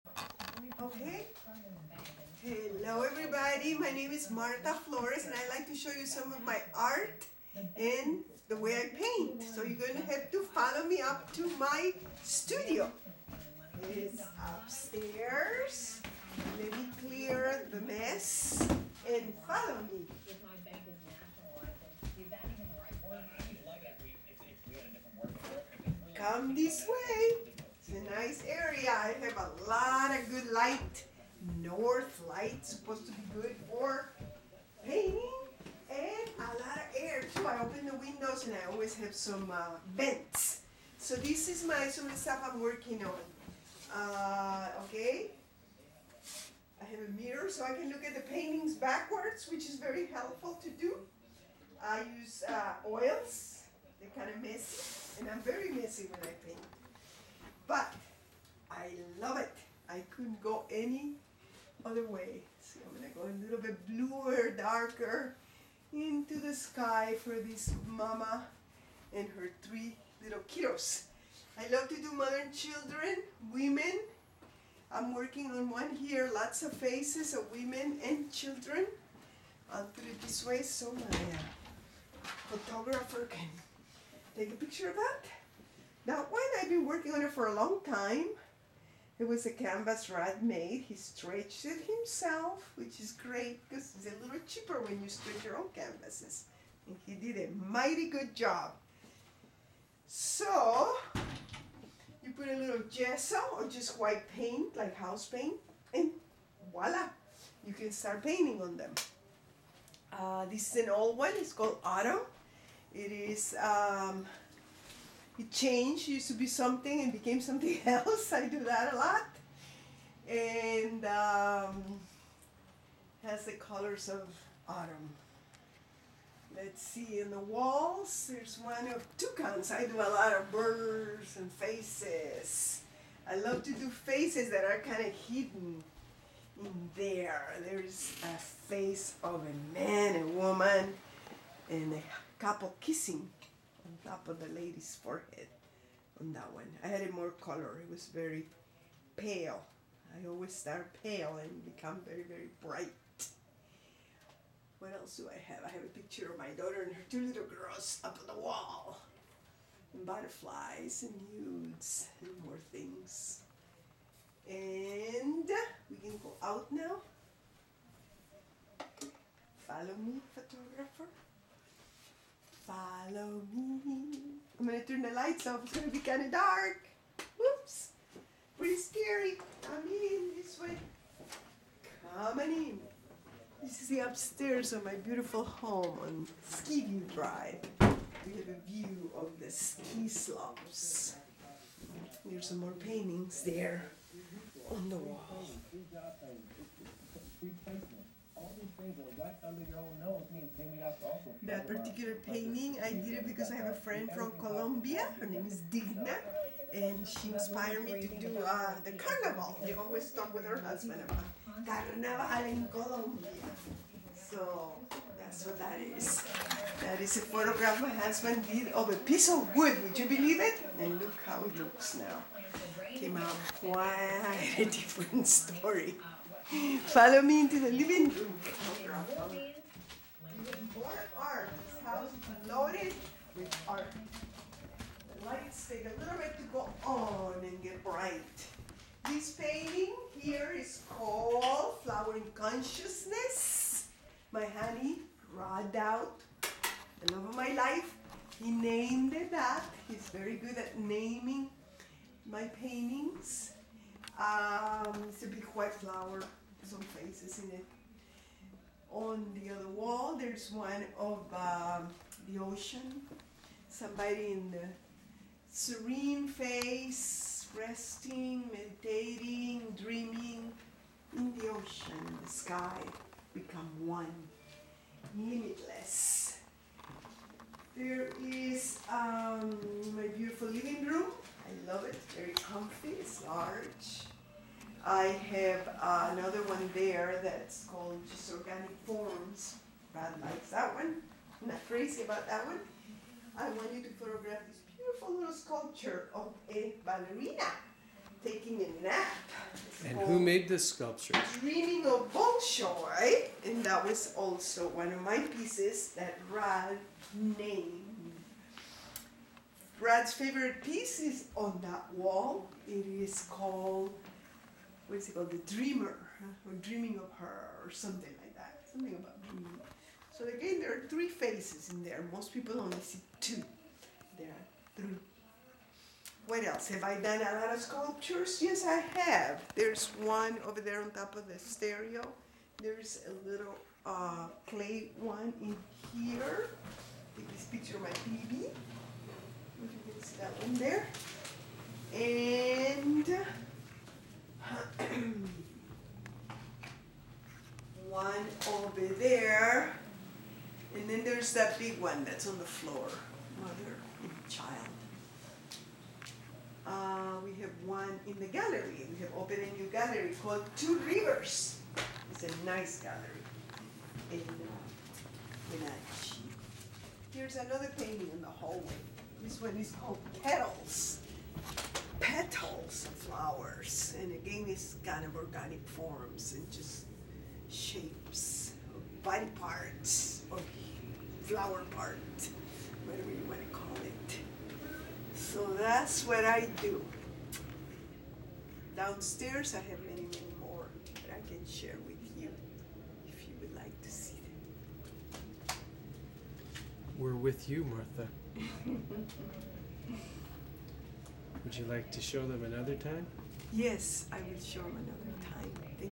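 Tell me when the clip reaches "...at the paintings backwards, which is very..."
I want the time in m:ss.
0:48.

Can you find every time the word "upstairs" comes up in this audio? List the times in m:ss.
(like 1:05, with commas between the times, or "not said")
0:14, 3:03.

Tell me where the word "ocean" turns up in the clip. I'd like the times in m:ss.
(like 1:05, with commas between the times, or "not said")
4:22, 4:31.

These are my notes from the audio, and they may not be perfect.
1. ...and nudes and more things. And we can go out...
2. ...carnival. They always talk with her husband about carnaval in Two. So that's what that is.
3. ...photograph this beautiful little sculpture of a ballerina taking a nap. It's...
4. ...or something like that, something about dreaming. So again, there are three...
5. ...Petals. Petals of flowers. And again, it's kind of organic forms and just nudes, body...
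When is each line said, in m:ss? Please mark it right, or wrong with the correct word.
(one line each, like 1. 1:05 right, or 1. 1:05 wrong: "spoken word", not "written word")
1. 2:41 right
2. 3:28 wrong: "Colombia", not "Two"
3. 4:53 right
4. 5:17 right
5. 6:10 wrong: "shapes", not "nudes".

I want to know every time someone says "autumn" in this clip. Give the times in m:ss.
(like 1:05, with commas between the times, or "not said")
1:51, 2:04.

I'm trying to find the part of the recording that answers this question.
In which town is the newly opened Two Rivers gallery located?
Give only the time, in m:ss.
6:05.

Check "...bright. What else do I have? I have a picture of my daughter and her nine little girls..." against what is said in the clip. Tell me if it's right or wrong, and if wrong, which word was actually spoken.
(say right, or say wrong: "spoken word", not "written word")
wrong: "two", not "nine".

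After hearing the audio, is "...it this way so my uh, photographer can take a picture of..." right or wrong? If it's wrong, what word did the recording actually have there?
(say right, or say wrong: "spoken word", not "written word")
right.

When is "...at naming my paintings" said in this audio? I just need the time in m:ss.
4:10.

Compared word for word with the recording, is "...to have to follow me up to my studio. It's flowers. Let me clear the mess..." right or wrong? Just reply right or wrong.
wrong.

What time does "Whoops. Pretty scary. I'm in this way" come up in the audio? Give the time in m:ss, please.
2:57.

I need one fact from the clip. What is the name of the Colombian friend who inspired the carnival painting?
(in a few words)
Digna.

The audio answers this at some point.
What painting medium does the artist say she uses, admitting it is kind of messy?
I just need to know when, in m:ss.
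0:52.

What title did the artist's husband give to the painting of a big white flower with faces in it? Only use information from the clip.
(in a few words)
Flowering Consciousness.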